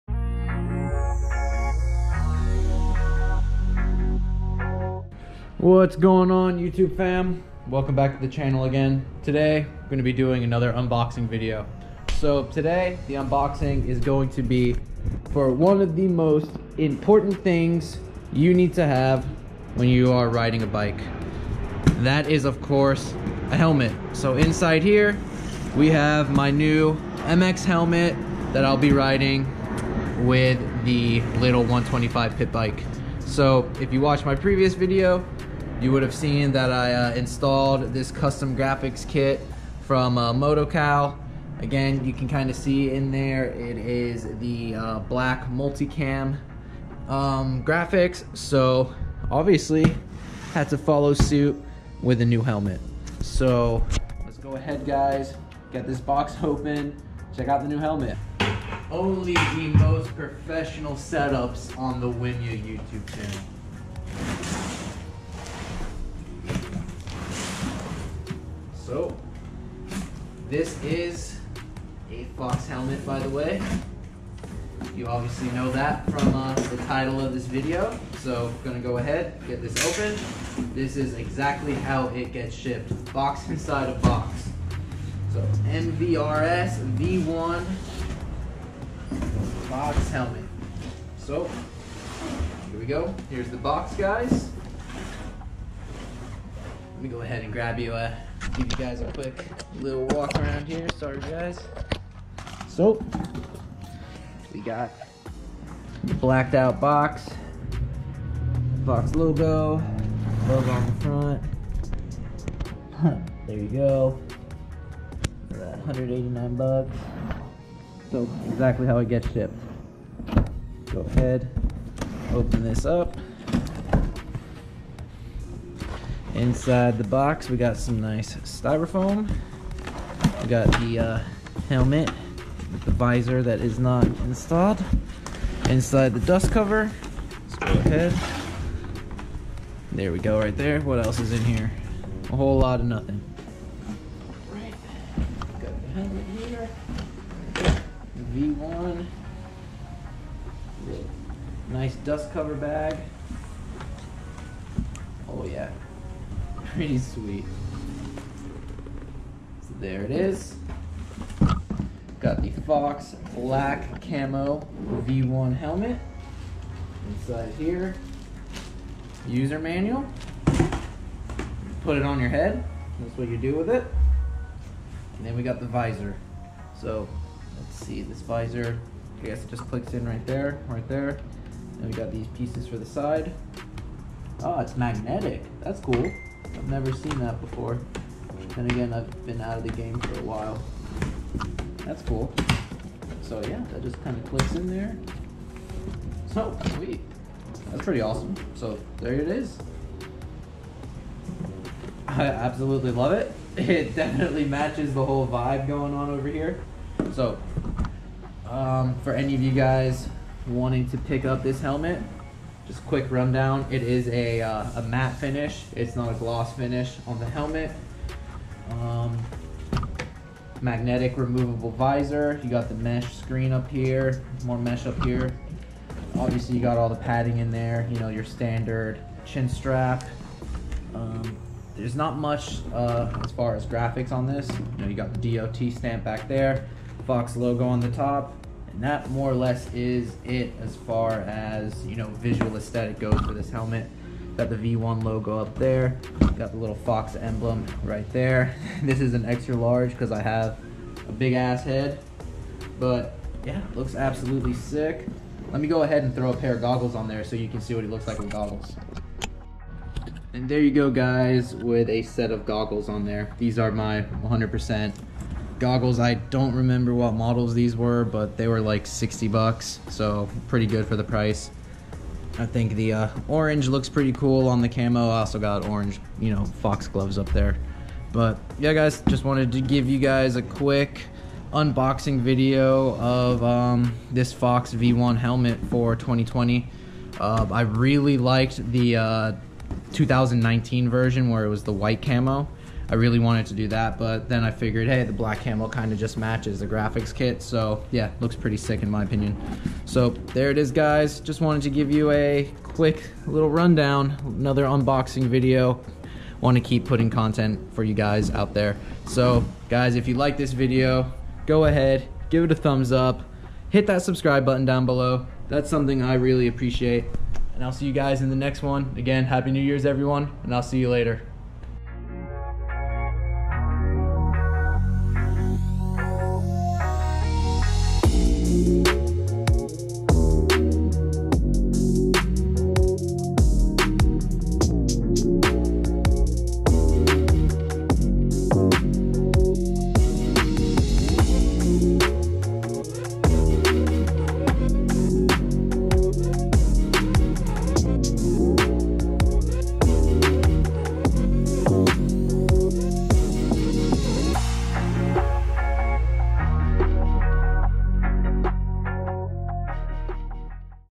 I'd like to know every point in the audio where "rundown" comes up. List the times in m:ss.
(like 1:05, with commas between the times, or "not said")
3:33, 5:03.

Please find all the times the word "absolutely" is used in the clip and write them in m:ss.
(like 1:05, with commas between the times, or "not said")
3:22, 4:13.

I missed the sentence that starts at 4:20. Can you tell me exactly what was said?
And there you go guys with a set of goggles on there.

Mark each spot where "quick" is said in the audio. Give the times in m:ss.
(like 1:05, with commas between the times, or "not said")
1:39, 3:32, 4:40, 5:02.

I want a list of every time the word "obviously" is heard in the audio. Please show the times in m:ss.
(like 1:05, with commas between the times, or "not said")
0:49, 1:15, 3:46.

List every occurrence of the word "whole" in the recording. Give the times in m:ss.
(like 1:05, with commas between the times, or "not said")
2:22, 3:25.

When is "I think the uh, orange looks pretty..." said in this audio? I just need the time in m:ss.
4:32.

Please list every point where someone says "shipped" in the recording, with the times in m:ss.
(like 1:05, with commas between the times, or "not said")
1:22, 1:59.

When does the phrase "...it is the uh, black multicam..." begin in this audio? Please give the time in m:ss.
0:43.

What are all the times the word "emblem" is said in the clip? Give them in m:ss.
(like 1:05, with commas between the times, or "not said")
4:07.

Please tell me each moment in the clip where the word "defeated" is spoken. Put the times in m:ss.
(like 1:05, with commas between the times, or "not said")
not said.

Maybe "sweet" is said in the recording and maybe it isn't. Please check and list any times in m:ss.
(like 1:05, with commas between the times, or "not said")
2:36, 3:16.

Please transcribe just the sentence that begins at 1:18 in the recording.
So I'm gonna go ahead, get this open.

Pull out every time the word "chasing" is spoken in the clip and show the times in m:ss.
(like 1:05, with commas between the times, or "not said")
not said.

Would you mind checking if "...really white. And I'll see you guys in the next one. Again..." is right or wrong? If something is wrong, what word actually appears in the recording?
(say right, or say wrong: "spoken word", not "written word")
wrong: "appreciate", not "white".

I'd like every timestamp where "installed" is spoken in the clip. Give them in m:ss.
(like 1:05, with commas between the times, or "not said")
0:37, 2:14.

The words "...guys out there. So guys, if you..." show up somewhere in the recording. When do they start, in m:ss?
5:07.